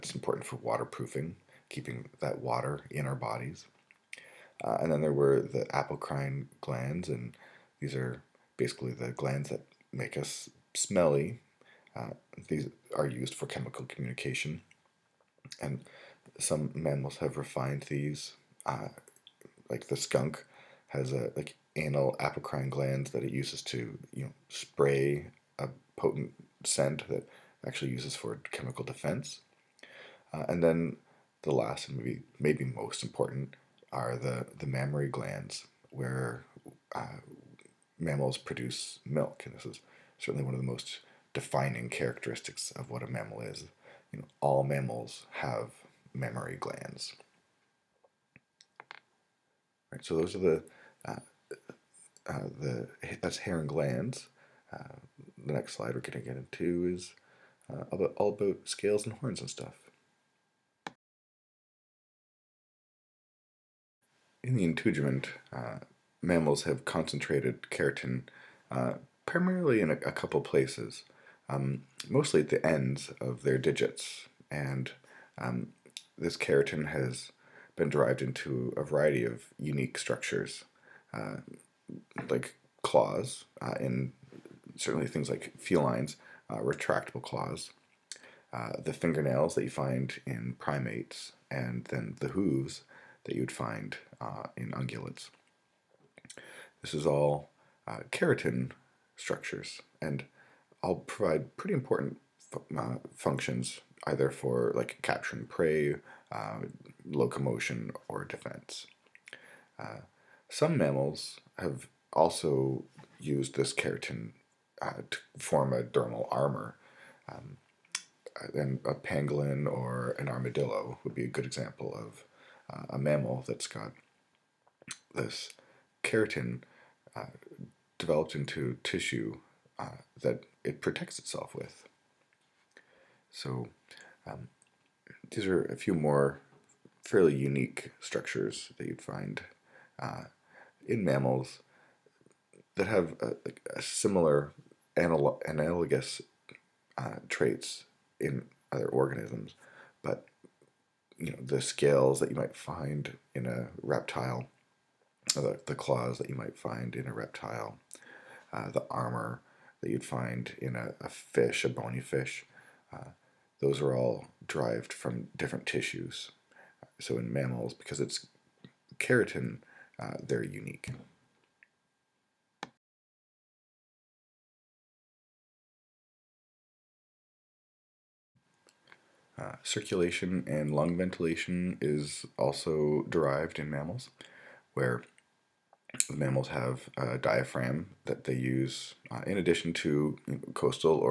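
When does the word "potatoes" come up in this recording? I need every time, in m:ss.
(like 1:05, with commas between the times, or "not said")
not said.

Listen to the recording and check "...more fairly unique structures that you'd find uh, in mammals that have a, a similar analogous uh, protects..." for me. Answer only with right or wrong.
wrong.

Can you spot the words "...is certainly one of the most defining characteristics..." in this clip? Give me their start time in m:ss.
0:39.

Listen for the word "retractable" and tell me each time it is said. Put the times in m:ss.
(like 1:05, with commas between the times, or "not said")
1:26.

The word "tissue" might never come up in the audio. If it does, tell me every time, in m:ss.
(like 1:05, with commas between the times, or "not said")
2:08, 2:45.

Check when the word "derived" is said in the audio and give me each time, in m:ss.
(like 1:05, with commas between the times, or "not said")
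1:17, 2:44, 3:03.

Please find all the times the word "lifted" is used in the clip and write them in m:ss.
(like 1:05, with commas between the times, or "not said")
not said.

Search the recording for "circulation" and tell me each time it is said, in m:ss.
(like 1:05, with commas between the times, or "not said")
2:59.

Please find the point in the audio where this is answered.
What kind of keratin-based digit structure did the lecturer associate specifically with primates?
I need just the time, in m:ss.
1:28.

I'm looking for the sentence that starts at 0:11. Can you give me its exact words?
Uh, these are used for chemical communication.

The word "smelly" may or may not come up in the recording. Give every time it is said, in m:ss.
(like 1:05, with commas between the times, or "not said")
0:10.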